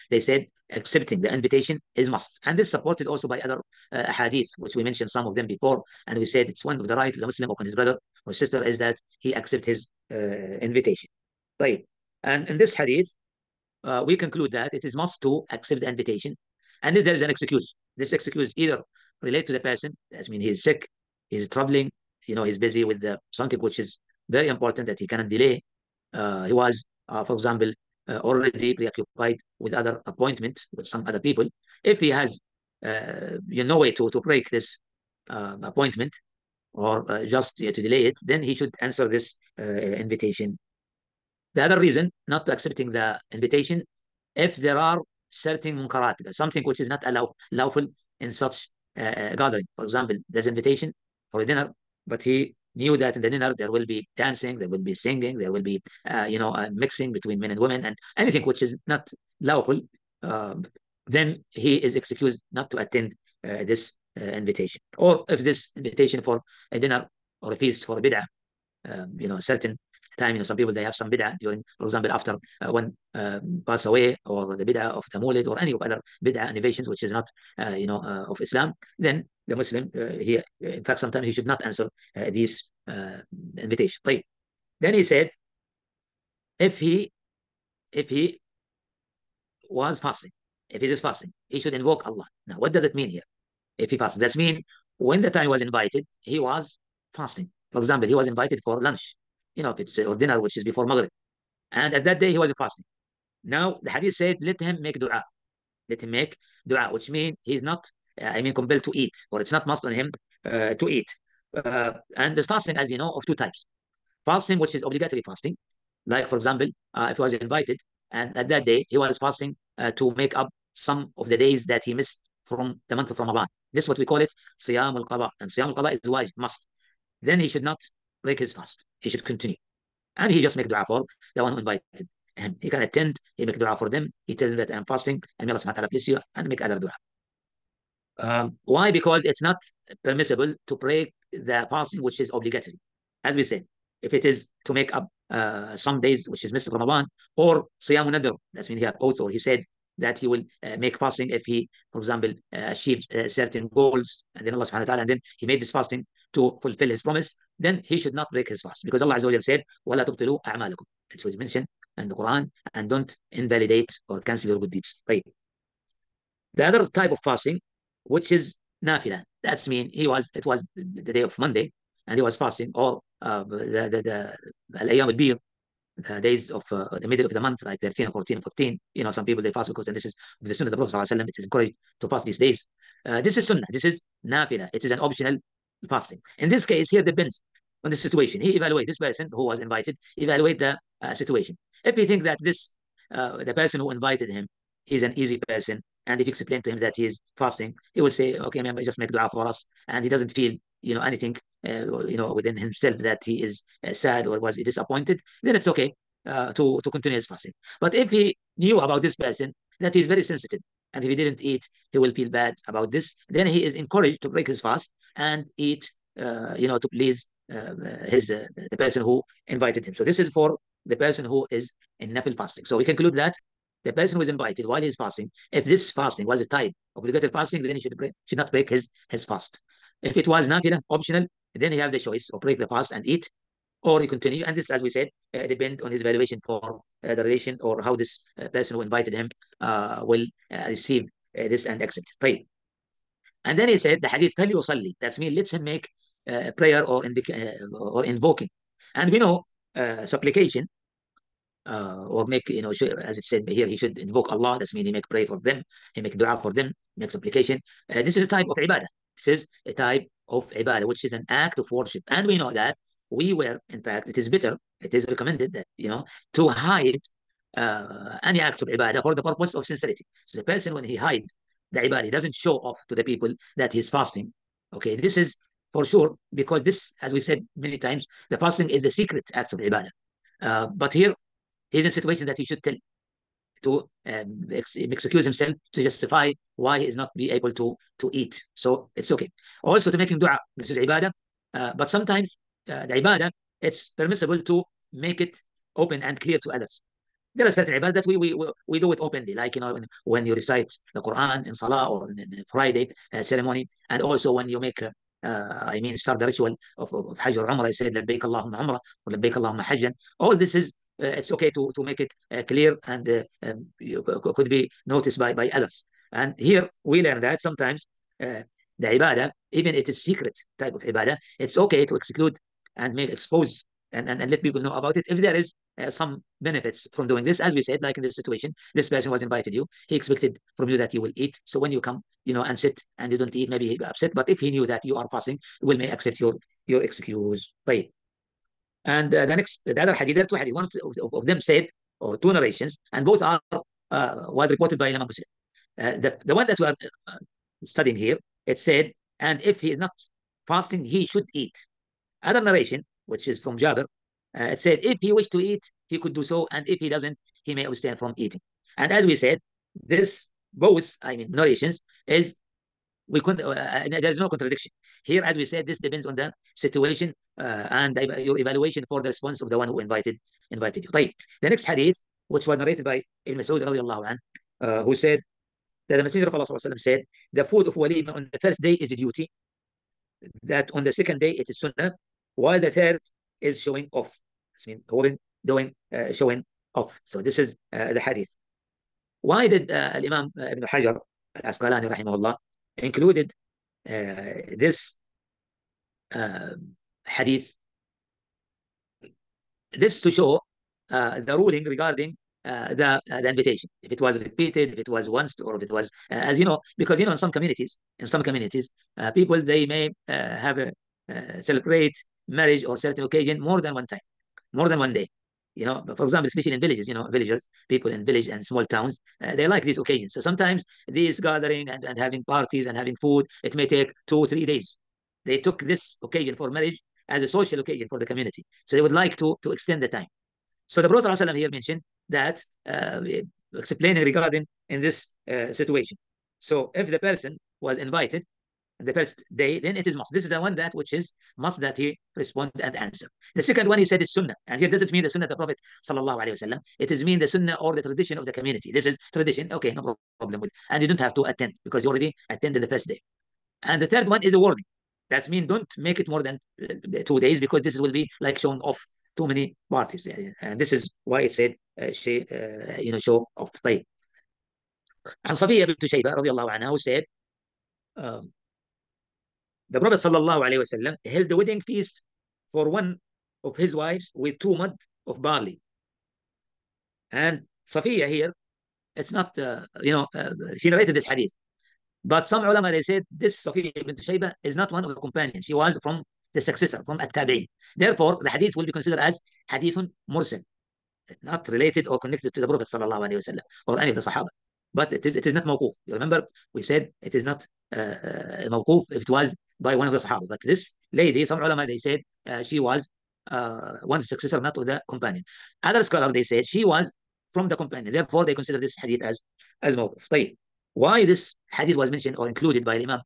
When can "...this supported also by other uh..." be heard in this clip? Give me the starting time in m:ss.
0:02.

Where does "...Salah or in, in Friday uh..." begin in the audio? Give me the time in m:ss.
5:01.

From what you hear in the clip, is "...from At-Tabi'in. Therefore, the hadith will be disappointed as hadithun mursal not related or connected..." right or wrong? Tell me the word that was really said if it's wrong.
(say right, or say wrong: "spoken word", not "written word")
wrong: "considered", not "disappointed".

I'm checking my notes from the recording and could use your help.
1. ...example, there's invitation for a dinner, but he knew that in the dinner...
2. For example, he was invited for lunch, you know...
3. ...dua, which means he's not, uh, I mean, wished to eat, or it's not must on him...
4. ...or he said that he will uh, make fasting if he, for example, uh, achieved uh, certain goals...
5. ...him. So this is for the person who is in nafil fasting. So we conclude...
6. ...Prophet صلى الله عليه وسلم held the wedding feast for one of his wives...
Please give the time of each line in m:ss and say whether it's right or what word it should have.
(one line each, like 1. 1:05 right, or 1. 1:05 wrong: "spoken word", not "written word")
1. 0:49 right
2. 1:37 right
3. 1:46 wrong: "compelled", not "wished"
4. 2:29 right
5. 3:39 right
6. 7:49 right.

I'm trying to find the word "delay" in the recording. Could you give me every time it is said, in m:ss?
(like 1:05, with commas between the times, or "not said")
0:25, 0:37.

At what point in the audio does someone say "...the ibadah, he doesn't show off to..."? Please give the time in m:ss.
4:31.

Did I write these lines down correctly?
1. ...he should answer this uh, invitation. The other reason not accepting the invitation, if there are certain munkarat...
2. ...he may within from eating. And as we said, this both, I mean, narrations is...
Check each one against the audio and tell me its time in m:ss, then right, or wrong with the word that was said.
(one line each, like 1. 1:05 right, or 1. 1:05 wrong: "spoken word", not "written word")
1. 0:38 right
2. 5:57 wrong: "abstain", not "within".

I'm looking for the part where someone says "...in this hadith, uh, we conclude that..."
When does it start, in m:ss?
0:12.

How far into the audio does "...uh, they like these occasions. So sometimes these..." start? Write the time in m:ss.
6:59.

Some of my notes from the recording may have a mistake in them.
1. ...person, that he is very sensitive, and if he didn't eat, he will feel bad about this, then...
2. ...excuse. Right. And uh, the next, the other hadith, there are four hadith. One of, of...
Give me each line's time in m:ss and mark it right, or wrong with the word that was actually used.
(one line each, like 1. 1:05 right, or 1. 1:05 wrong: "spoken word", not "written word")
1. 3:29 right
2. 5:36 wrong: "two", not "four".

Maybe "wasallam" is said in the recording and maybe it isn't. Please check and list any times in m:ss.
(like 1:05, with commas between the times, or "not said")
7:26, 8:13.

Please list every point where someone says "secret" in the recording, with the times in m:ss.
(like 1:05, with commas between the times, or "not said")
4:38, 5:20.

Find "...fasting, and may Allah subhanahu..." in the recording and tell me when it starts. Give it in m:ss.
2:14.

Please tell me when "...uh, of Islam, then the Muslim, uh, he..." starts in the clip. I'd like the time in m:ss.
1:18.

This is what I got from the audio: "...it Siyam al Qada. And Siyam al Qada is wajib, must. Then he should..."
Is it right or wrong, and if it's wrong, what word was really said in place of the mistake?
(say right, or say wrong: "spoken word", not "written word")
right.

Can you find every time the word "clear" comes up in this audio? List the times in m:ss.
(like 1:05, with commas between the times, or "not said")
4:56, 5:12.